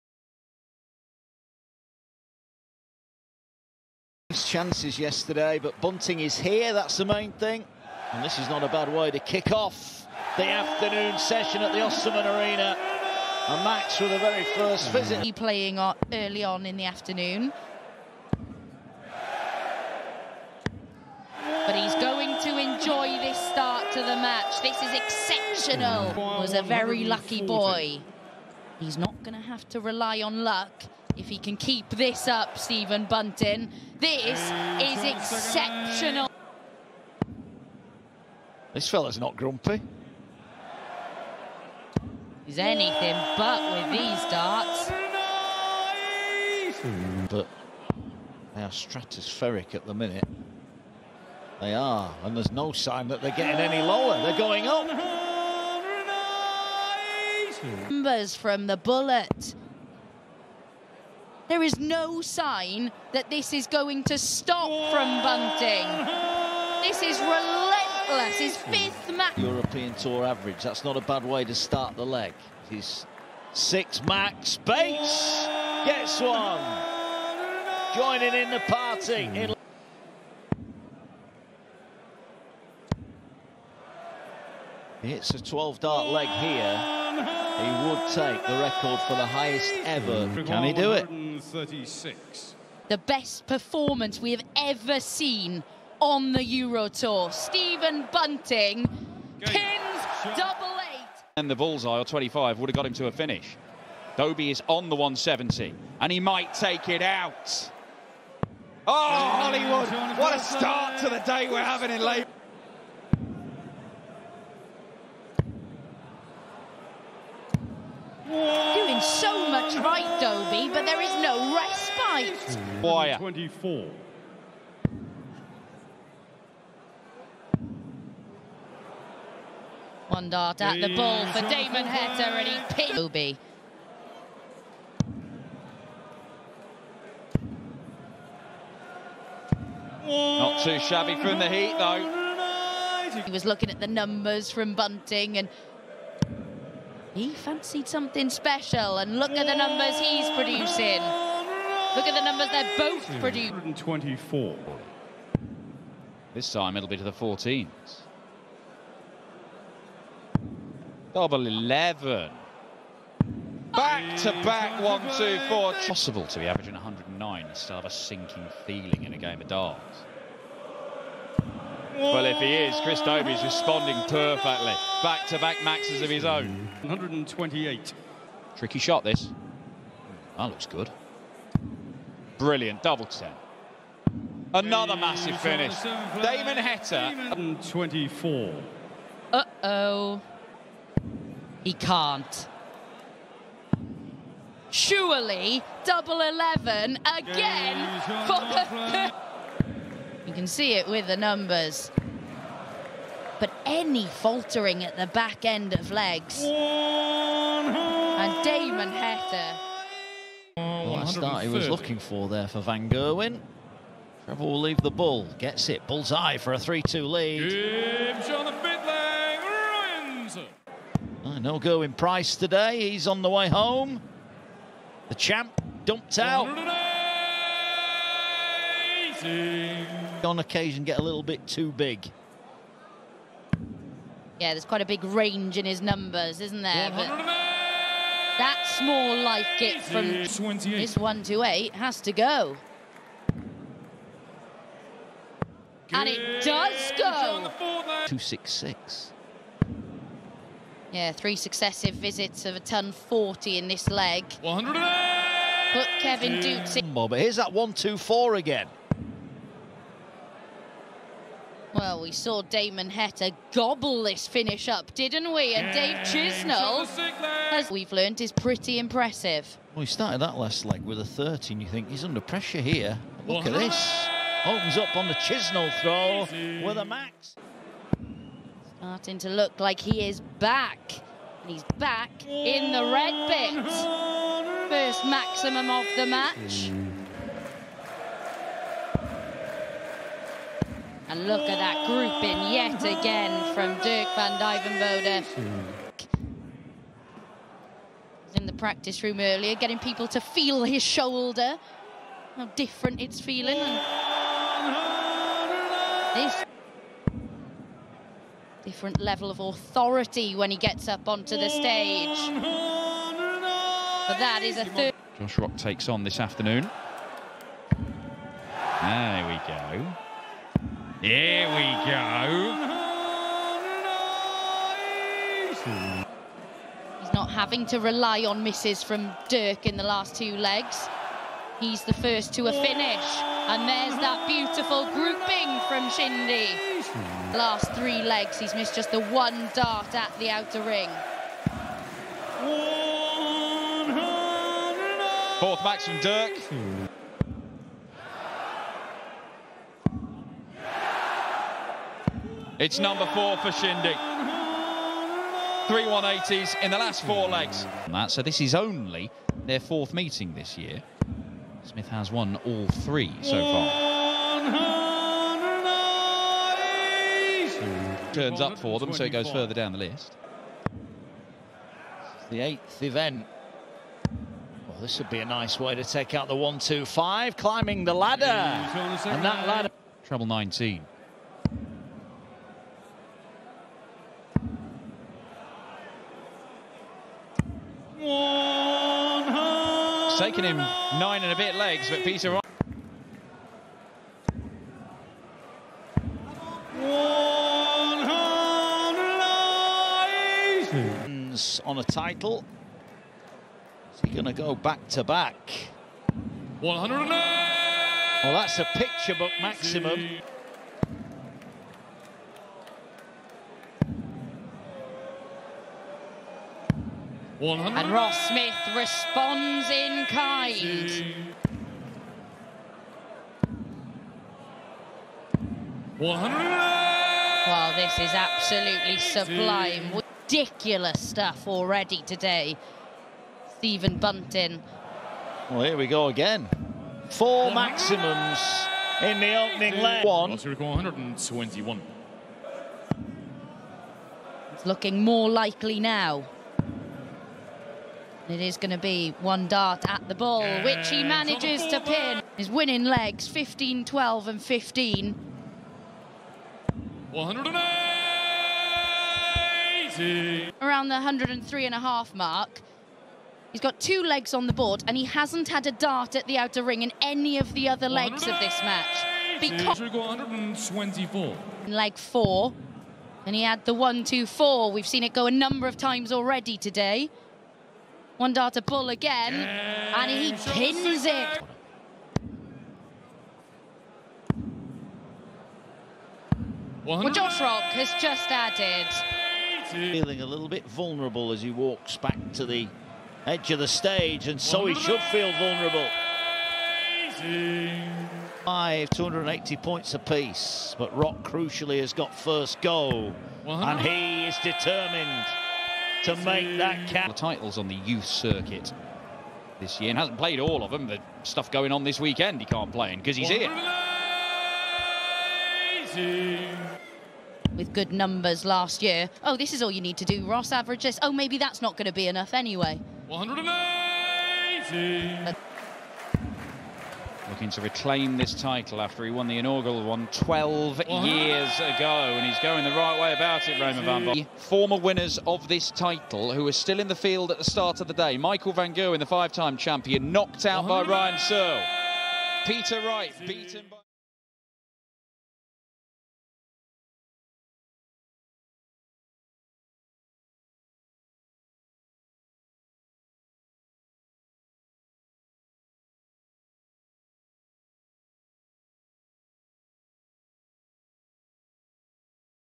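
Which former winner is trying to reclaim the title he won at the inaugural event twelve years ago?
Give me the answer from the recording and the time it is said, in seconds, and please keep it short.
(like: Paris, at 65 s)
Raymond Van Barneveld, at 533 s.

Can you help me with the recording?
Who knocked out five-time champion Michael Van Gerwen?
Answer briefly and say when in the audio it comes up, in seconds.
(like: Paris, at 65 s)
Ryan Searle, at 540 s.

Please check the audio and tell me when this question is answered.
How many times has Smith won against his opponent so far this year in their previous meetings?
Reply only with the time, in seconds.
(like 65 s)
362 s.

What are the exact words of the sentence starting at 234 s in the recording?
Yeah, there's quite a big range in his numbers, isn't there?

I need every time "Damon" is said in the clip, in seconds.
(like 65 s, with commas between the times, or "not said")
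131 s, 185 s, 208 s, 262 s.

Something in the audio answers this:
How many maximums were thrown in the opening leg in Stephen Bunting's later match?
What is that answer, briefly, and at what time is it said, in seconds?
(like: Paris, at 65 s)
4, at 437 s.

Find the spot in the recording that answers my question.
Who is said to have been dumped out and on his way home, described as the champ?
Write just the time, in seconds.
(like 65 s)
221 s.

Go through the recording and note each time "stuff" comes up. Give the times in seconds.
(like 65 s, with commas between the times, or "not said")
431 s, 511 s.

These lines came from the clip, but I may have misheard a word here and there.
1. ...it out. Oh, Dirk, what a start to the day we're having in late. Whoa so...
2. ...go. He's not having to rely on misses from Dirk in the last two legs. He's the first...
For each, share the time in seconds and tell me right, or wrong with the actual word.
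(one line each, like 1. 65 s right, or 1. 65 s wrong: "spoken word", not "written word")
1. 106 s wrong: "Hollywood", not "Dirk"
2. 321 s right.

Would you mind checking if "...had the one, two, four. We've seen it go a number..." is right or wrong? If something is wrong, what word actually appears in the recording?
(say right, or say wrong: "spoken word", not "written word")
right.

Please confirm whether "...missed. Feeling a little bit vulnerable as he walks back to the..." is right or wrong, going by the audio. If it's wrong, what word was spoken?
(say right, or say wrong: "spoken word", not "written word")
wrong: "added", not "missed".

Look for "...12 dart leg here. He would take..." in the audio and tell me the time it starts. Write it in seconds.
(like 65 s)
85 s.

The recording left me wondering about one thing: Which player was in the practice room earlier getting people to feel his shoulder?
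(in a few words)
Dirk van Duijvenbode.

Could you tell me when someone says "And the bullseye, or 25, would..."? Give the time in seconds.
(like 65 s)
101 s.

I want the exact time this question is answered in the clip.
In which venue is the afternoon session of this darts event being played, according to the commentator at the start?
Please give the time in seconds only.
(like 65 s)
11 s.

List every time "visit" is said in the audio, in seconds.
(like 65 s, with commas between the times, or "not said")
14 s, 251 s.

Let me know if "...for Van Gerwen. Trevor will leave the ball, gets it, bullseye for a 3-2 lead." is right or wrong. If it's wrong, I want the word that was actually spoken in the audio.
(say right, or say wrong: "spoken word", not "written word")
right.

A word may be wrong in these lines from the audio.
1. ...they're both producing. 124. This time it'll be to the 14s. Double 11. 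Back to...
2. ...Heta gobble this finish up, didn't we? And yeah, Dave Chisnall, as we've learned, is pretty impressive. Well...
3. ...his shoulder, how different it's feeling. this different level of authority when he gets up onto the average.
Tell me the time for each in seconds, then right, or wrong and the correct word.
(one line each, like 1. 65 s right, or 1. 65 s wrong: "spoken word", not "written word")
1. 152 s right
2. 262 s right
3. 300 s wrong: "stage", not "average".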